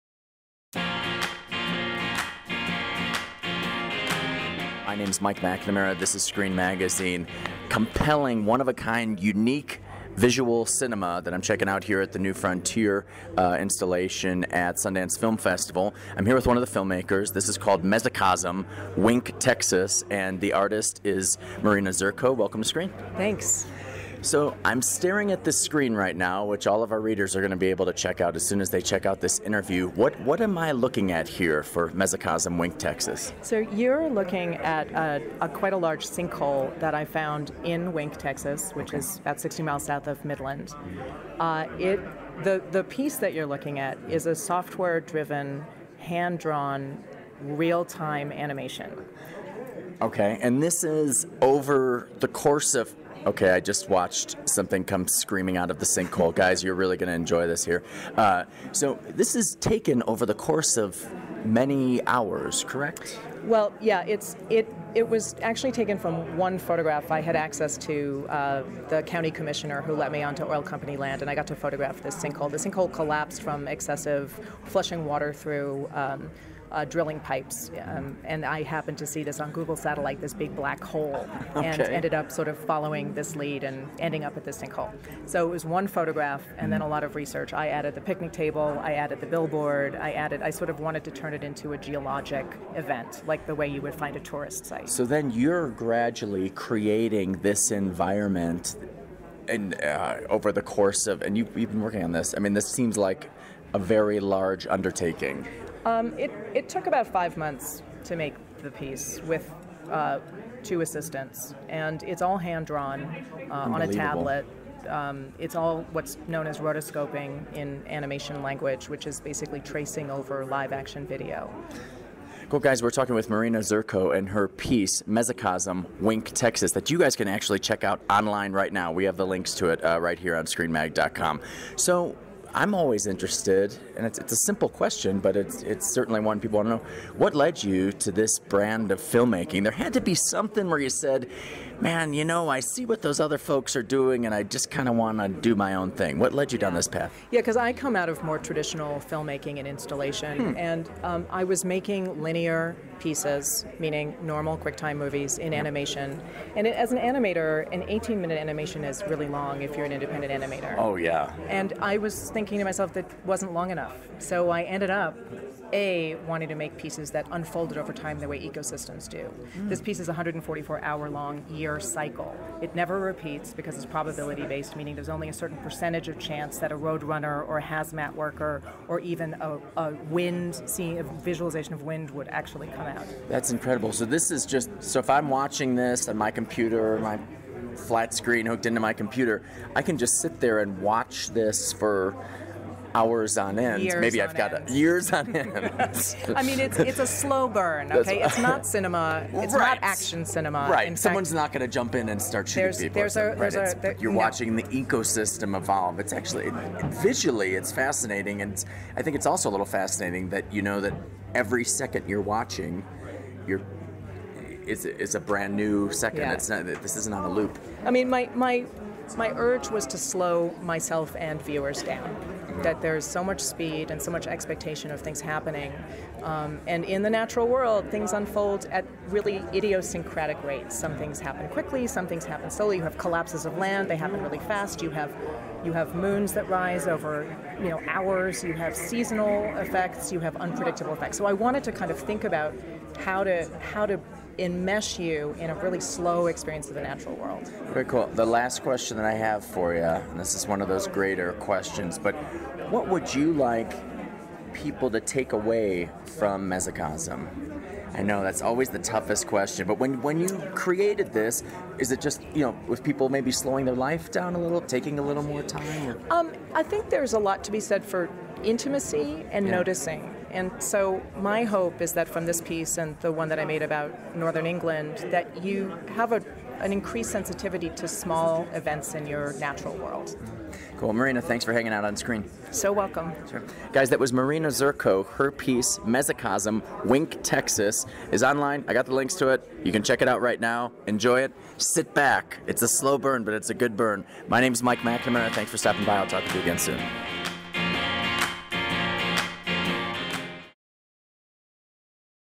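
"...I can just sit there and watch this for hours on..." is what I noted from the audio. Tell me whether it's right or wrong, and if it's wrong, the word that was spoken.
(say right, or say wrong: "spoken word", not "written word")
right.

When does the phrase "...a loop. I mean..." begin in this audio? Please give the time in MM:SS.
03:37.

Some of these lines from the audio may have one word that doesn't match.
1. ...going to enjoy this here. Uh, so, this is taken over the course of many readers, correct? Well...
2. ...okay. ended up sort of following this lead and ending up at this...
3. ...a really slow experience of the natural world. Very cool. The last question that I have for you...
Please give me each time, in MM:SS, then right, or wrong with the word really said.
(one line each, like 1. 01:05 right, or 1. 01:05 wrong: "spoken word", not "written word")
1. 00:56 wrong: "hours", not "readers"
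2. 01:21 right
3. 04:05 right.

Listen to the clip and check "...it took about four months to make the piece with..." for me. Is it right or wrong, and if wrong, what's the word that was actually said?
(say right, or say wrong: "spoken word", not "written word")
wrong: "five", not "four".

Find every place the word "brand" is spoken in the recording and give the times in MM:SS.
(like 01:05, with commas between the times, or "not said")
02:18, 03:35.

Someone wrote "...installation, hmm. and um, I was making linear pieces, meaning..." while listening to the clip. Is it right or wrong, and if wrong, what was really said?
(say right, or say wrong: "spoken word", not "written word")
right.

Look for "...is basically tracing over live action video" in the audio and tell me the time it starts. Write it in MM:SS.
01:59.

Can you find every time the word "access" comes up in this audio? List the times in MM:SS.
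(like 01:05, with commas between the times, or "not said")
01:07.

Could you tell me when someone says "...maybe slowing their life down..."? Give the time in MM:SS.
04:23.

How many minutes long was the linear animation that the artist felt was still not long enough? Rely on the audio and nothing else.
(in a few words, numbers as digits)
18.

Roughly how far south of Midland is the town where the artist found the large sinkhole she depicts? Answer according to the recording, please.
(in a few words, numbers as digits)
60 miles.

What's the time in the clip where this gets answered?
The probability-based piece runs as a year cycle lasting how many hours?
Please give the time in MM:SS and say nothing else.
02:50.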